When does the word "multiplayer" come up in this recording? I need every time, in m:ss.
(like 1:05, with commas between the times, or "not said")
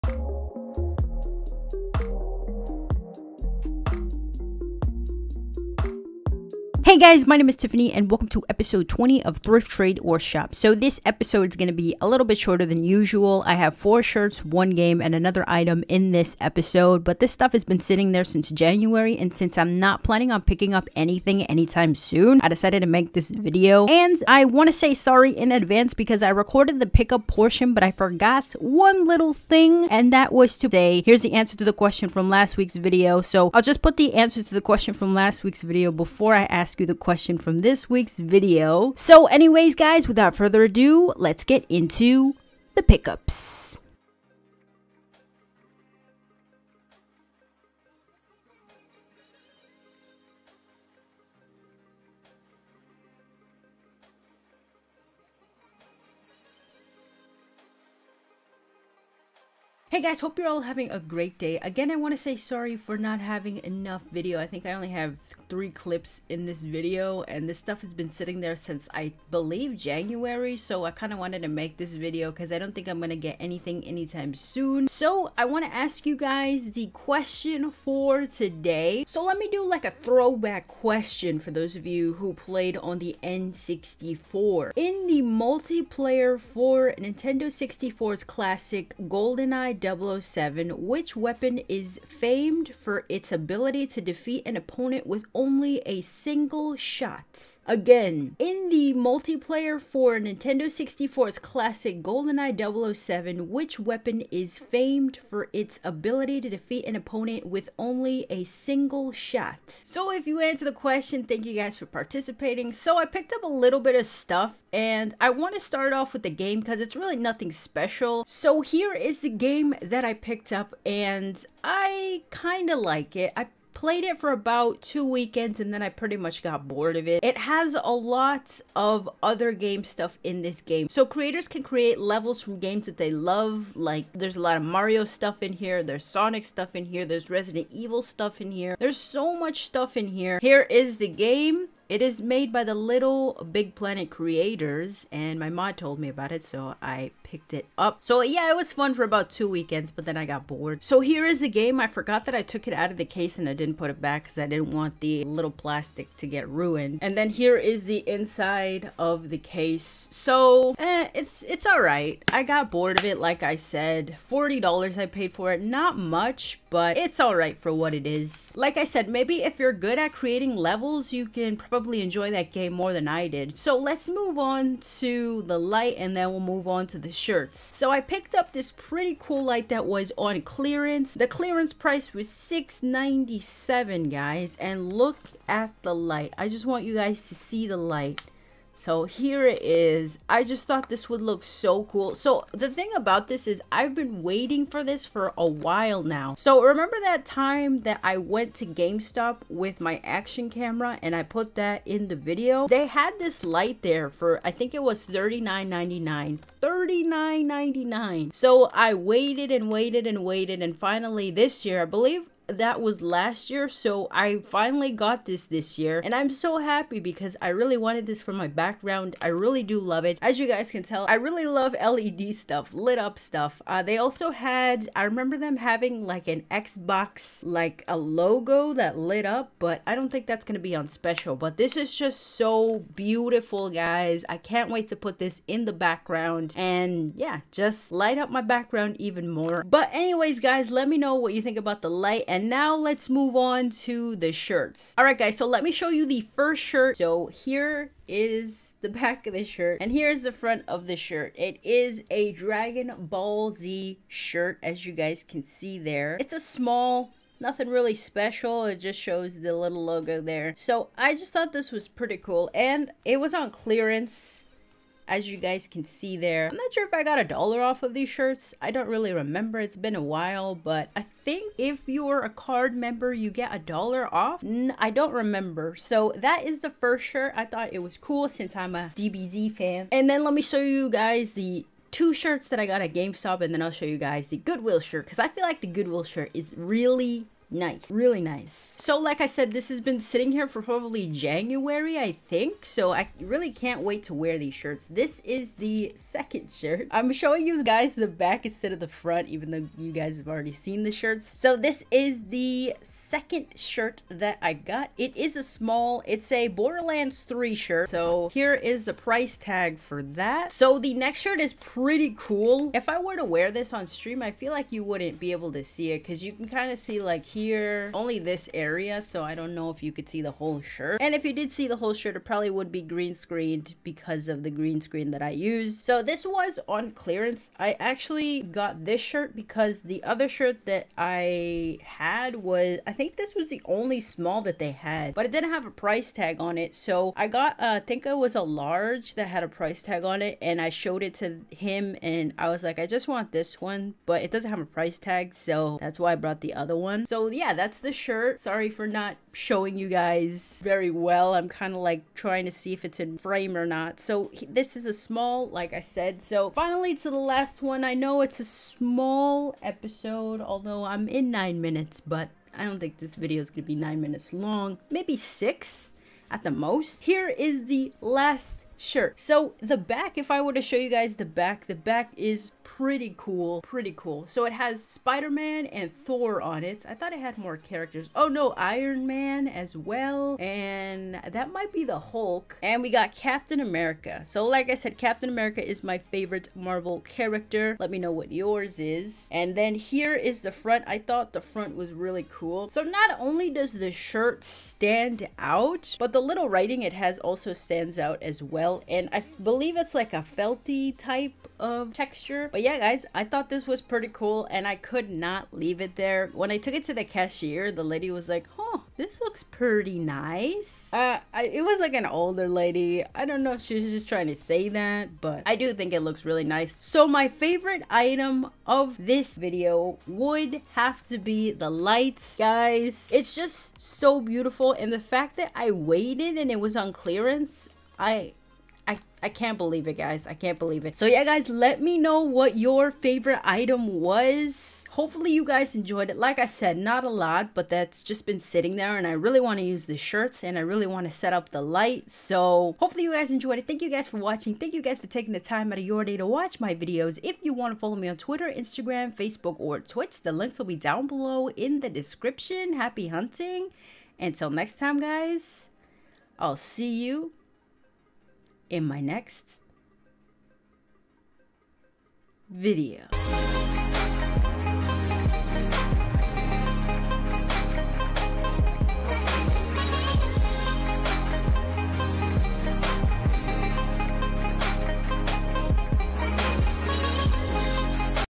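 1:25, 1:38.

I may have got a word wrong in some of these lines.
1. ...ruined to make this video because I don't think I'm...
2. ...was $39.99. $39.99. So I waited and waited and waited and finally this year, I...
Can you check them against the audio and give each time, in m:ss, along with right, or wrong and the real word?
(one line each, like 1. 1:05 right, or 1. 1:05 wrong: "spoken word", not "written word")
1. 1:11 wrong: "wanted", not "ruined"
2. 3:24 right.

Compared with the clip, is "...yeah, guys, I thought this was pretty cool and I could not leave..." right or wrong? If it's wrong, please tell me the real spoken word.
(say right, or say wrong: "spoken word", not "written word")
right.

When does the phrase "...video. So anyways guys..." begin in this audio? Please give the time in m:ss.
0:38.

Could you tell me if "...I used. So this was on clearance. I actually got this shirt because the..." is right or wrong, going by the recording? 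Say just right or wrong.
right.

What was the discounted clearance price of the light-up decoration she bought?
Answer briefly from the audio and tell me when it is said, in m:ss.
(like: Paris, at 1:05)
$6.97, at 3:02.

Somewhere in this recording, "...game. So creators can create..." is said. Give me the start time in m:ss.
2:10.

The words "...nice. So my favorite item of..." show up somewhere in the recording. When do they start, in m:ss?
6:56.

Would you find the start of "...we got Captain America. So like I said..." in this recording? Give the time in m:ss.
6:22.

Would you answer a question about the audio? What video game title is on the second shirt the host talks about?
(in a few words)
Borderlands 3.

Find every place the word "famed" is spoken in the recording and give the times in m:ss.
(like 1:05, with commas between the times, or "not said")
1:32, 1:44.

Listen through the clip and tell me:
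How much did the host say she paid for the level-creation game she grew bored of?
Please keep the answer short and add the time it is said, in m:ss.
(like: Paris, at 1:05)
$40, at 2:44.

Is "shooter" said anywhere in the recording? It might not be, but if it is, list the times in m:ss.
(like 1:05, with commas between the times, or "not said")
not said.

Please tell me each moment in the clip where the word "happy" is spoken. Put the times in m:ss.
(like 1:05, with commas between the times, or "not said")
3:36, 7:32.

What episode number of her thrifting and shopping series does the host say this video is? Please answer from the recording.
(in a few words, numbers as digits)
20.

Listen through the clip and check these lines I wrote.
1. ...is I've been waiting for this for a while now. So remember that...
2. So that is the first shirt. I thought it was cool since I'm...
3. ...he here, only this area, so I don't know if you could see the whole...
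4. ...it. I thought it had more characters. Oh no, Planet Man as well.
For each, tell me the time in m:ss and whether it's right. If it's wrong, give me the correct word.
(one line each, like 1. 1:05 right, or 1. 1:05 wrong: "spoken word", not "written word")
1. 3:13 right
2. 4:35 right
3. 5:17 right
4. 6:16 wrong: "Iron", not "Planet".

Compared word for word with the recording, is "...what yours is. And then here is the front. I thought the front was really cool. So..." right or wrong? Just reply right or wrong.
right.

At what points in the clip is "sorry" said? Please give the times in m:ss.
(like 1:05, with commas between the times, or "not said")
0:24, 1:02, 5:48.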